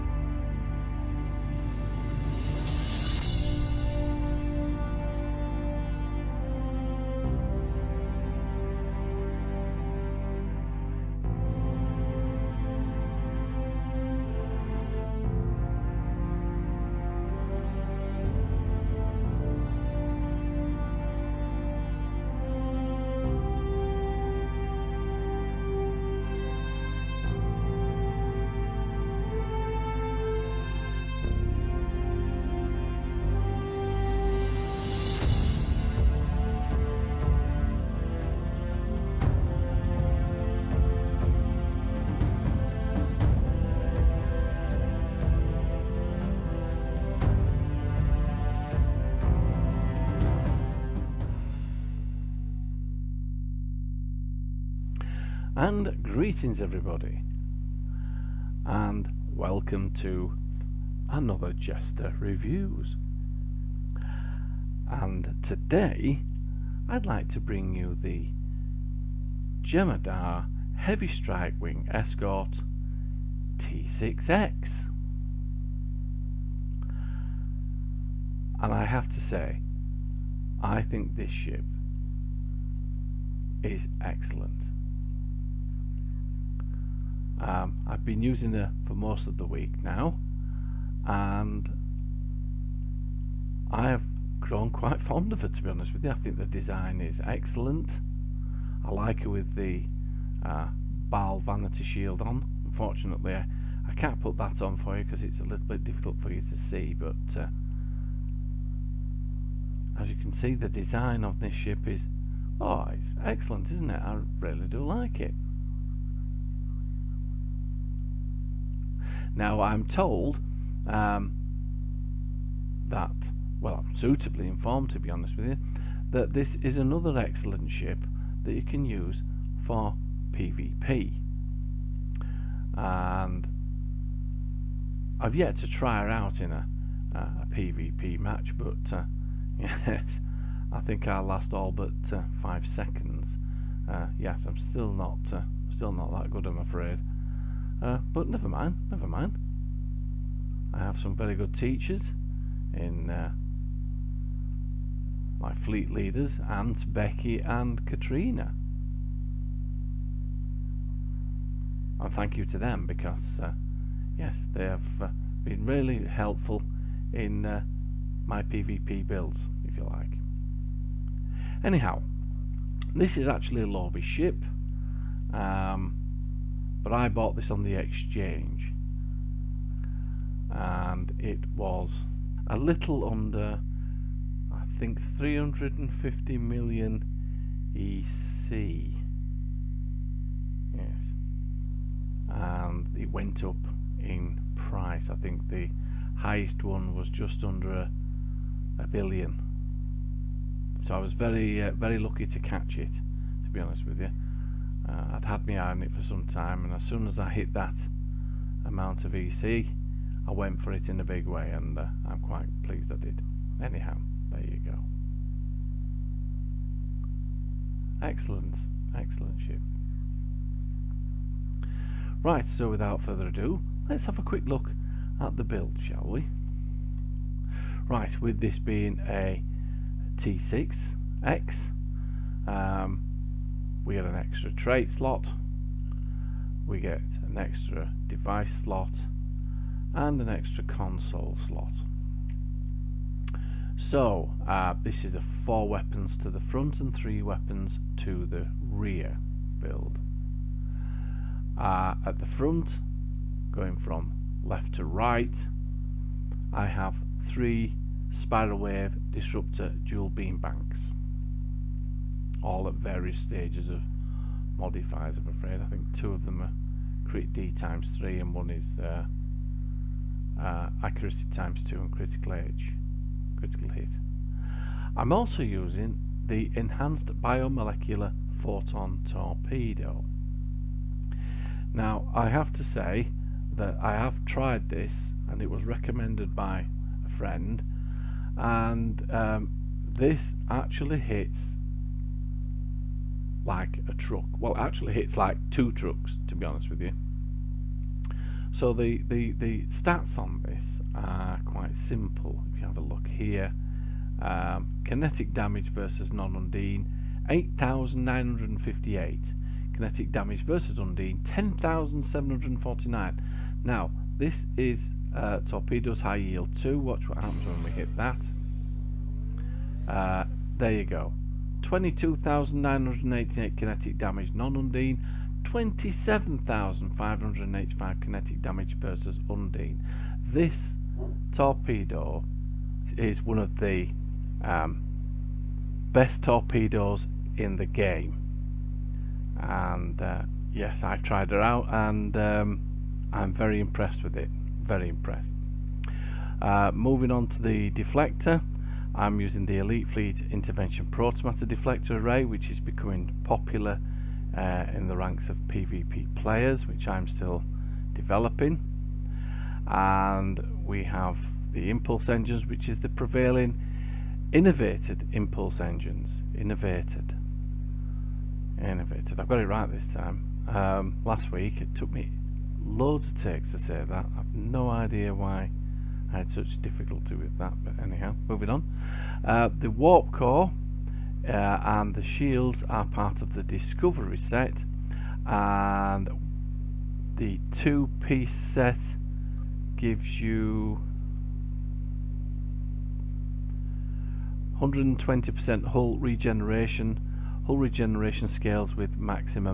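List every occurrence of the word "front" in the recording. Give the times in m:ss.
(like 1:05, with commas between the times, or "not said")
4:06, 4:12.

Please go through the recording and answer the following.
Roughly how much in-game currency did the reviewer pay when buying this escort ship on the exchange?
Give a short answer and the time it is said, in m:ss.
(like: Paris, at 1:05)
350 million EC, at 3:04.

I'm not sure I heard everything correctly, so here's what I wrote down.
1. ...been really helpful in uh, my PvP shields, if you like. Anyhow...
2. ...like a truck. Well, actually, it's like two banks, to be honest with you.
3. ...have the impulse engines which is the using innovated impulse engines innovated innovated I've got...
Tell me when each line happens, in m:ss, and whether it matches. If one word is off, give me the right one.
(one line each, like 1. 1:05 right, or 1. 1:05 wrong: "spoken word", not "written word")
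1. 2:45 wrong: "builds", not "shields"
2. 4:53 wrong: "trucks", not "banks"
3. 6:00 wrong: "prevailing", not "using".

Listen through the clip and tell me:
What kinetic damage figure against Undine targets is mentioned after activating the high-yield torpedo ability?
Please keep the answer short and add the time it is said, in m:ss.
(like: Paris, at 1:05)
27,585, at 5:25.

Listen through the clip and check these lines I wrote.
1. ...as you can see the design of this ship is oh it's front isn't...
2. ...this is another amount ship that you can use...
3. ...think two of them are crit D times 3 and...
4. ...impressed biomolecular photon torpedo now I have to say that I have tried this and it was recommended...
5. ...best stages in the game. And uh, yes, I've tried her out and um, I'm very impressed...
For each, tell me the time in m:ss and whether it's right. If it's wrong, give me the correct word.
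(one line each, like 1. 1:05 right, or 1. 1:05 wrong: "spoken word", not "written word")
1. 1:49 wrong: "excellent", not "front"
2. 2:06 wrong: "excellent", not "amount"
3. 4:25 right
4. 4:36 wrong: "enhanced", not "impressed"
5. 5:35 wrong: "torpedoes", not "stages".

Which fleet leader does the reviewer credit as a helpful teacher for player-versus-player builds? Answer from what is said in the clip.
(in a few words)
Aunt Becky.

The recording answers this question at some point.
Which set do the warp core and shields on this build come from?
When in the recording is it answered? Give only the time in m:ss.
6:23.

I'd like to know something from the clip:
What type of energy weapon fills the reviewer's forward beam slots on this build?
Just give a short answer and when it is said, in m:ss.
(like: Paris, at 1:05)
spiral wave disruptor dual beam banks, at 4:18.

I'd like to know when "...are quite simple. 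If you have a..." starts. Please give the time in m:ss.
5:00.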